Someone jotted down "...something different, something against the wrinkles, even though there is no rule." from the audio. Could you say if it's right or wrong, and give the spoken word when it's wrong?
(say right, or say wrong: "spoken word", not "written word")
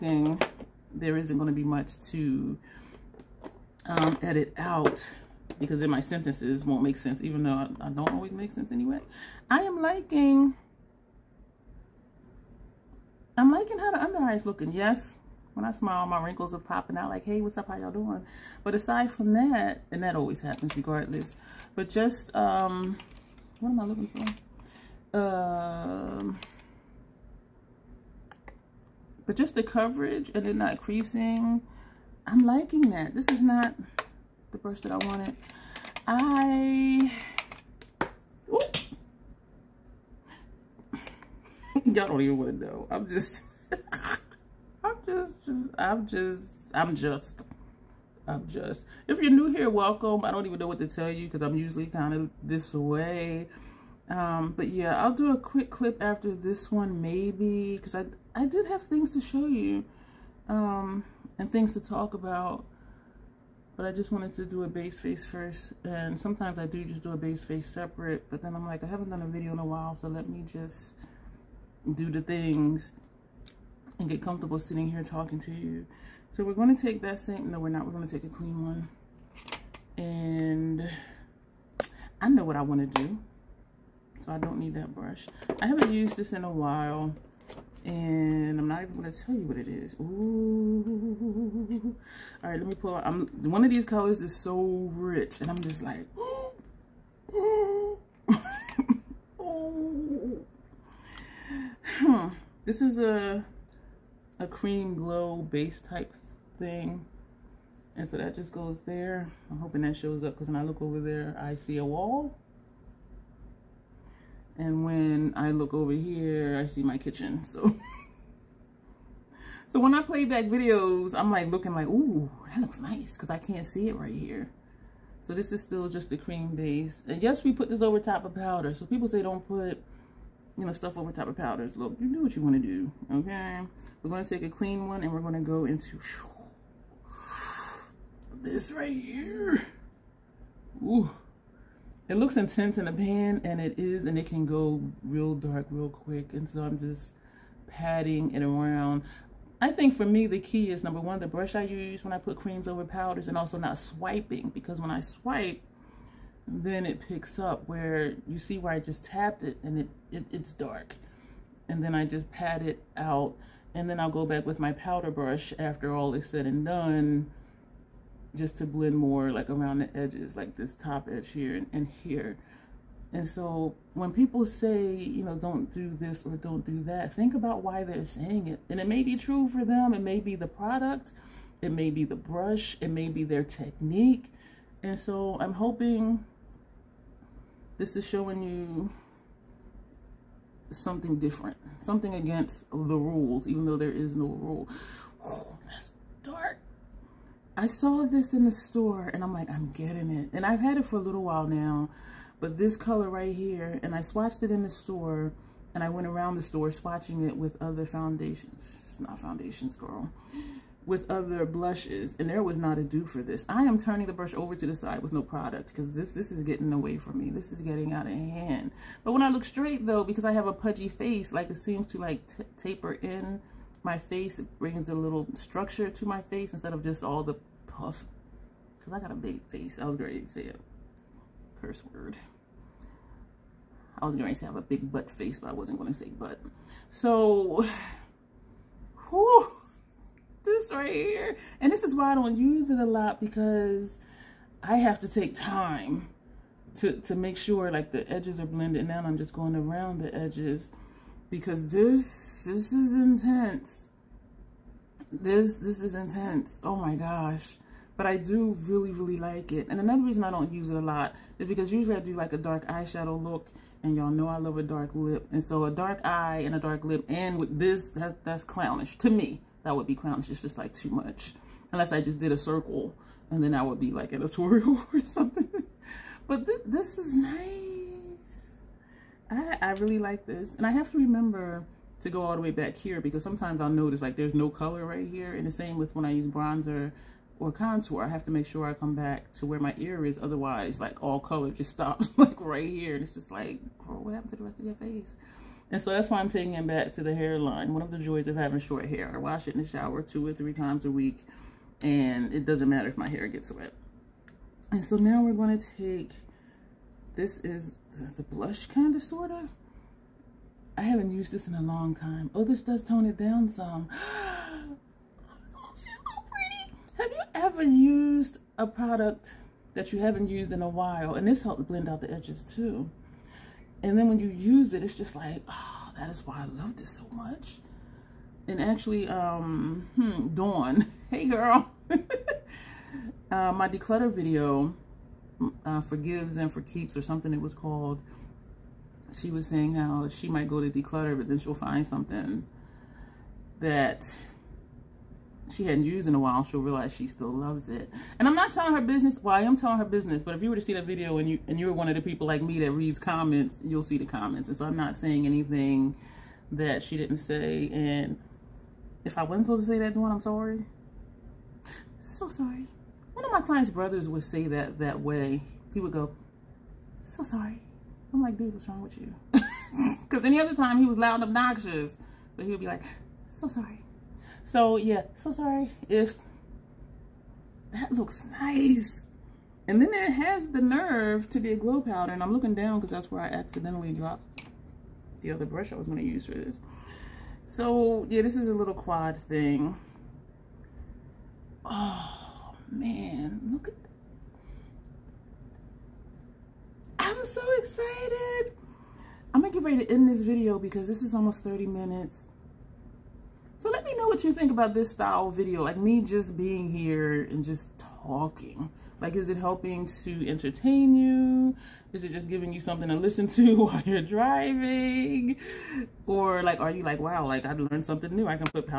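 wrong: "rules", not "wrinkles".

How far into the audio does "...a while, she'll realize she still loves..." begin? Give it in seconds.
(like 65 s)
346 s.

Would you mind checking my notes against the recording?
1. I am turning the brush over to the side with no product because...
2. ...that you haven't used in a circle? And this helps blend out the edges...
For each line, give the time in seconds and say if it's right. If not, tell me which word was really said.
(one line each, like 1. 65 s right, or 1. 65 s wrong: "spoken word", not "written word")
1. 213 s right
2. 319 s wrong: "while", not "circle".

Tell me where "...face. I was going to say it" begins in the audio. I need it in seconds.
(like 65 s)
229 s.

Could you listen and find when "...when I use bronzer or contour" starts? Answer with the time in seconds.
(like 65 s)
285 s.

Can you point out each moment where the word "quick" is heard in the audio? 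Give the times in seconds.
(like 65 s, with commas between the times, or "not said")
55 s, 145 s.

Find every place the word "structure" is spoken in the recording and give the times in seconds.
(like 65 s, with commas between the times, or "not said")
225 s.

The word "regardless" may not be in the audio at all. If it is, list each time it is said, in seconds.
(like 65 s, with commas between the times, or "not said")
20 s.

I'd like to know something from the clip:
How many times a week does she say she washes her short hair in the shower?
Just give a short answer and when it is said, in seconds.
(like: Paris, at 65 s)
2 or 3, at 300 s.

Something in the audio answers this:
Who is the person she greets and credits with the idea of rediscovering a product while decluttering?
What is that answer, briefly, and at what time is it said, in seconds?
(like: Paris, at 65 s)
Dawn, at 330 s.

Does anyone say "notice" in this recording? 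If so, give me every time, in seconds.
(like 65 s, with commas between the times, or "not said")
283 s.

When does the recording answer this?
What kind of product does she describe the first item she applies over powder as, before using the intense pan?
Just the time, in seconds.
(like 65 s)
104 s.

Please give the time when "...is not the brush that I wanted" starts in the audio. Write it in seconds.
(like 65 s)
33 s.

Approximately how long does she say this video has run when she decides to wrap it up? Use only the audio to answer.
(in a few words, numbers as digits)
almost 30 minutes.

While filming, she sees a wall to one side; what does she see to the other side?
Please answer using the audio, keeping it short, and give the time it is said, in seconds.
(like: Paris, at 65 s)
kitchen, at 116 s.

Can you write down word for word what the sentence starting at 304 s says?
And so now we're going to take, this is the blush kind of, sort of.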